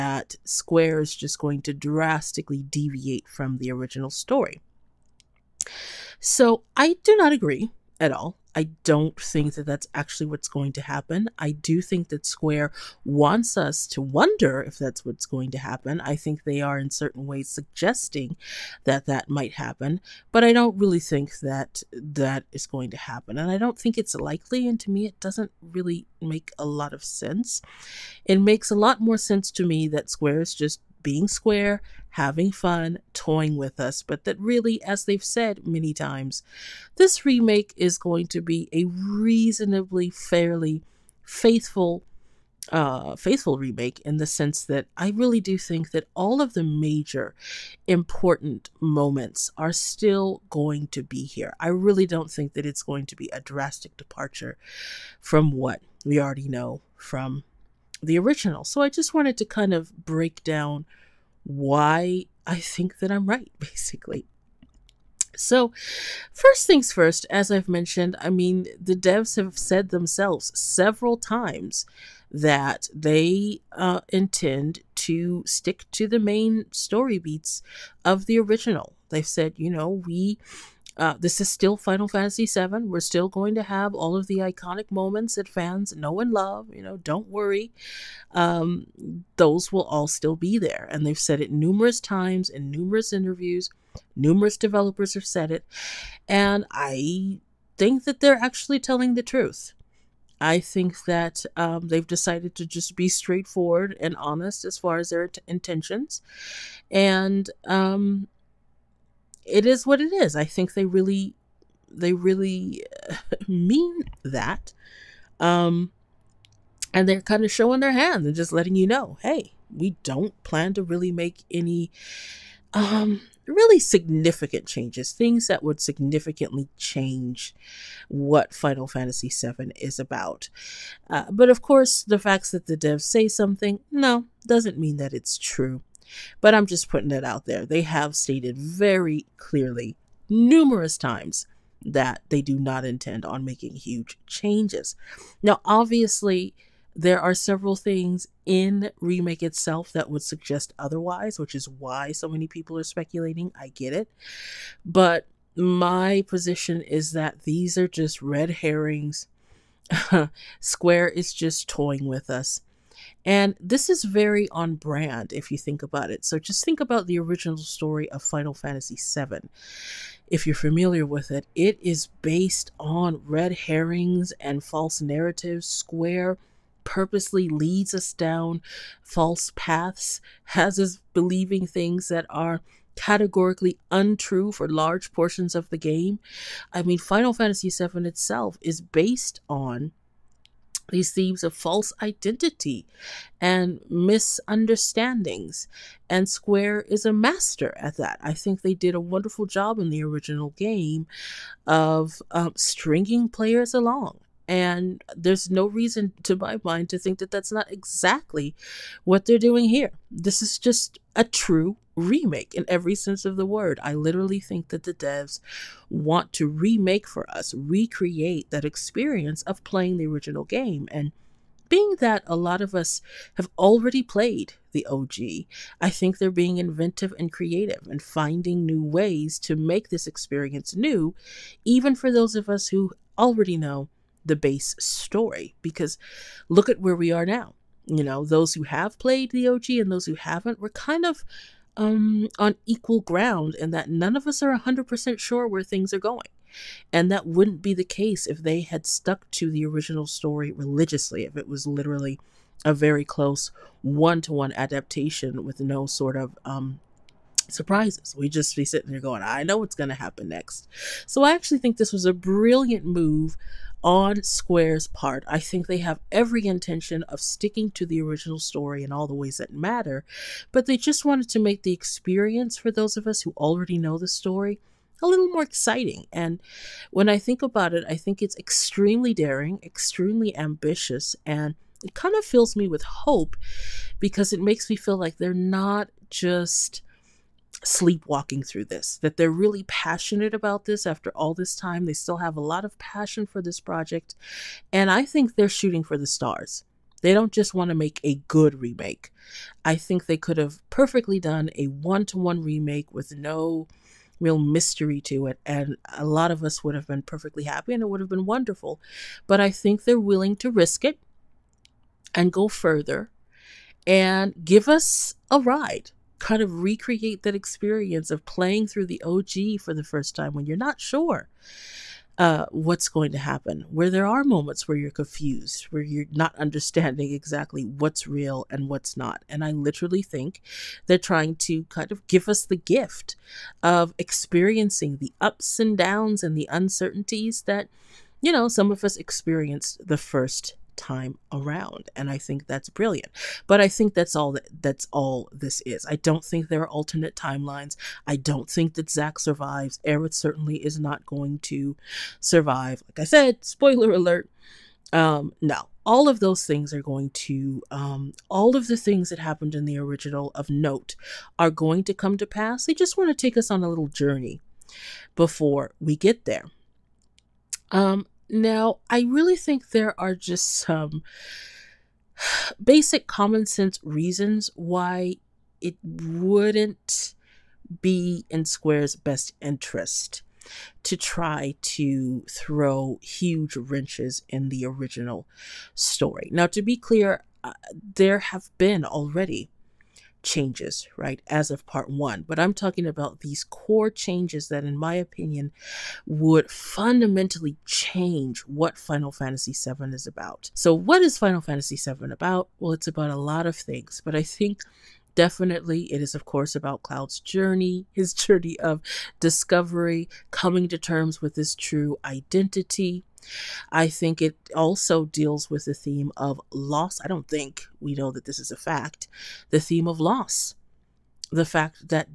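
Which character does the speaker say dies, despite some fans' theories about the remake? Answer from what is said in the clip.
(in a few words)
Zack.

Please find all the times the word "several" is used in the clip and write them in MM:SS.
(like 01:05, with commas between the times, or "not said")
01:10, 02:27.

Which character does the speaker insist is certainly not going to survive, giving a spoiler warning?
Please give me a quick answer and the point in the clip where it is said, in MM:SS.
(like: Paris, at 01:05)
Aerith, at 05:49.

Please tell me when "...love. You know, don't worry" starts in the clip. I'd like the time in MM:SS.
01:26.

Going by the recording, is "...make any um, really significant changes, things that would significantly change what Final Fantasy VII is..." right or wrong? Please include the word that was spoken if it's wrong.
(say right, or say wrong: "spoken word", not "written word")
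right.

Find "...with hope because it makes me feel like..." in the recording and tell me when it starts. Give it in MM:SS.
04:42.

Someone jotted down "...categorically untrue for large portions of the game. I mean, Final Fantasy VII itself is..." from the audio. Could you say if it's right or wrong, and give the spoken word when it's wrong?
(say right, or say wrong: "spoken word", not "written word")
right.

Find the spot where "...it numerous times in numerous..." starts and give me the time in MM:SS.
01:31.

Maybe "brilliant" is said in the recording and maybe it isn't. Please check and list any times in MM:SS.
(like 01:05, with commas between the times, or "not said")
04:22, 05:42.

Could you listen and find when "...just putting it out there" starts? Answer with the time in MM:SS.
02:16.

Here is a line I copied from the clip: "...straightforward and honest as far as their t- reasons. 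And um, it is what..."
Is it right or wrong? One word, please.
wrong.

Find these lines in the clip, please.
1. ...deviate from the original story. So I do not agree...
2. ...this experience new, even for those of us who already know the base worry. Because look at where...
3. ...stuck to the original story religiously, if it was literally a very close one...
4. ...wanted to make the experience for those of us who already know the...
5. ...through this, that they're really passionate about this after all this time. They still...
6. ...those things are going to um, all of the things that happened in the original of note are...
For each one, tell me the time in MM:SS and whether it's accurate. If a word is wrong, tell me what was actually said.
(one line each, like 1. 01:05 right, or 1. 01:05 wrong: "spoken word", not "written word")
1. 00:02 right
2. 03:49 wrong: "story", not "worry"
3. 04:08 right
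4. 04:31 right
5. 04:48 right
6. 05:56 right.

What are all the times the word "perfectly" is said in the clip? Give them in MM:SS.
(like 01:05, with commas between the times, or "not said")
05:00, 05:07.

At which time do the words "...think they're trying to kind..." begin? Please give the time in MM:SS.
05:30.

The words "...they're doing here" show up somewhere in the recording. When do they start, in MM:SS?
03:29.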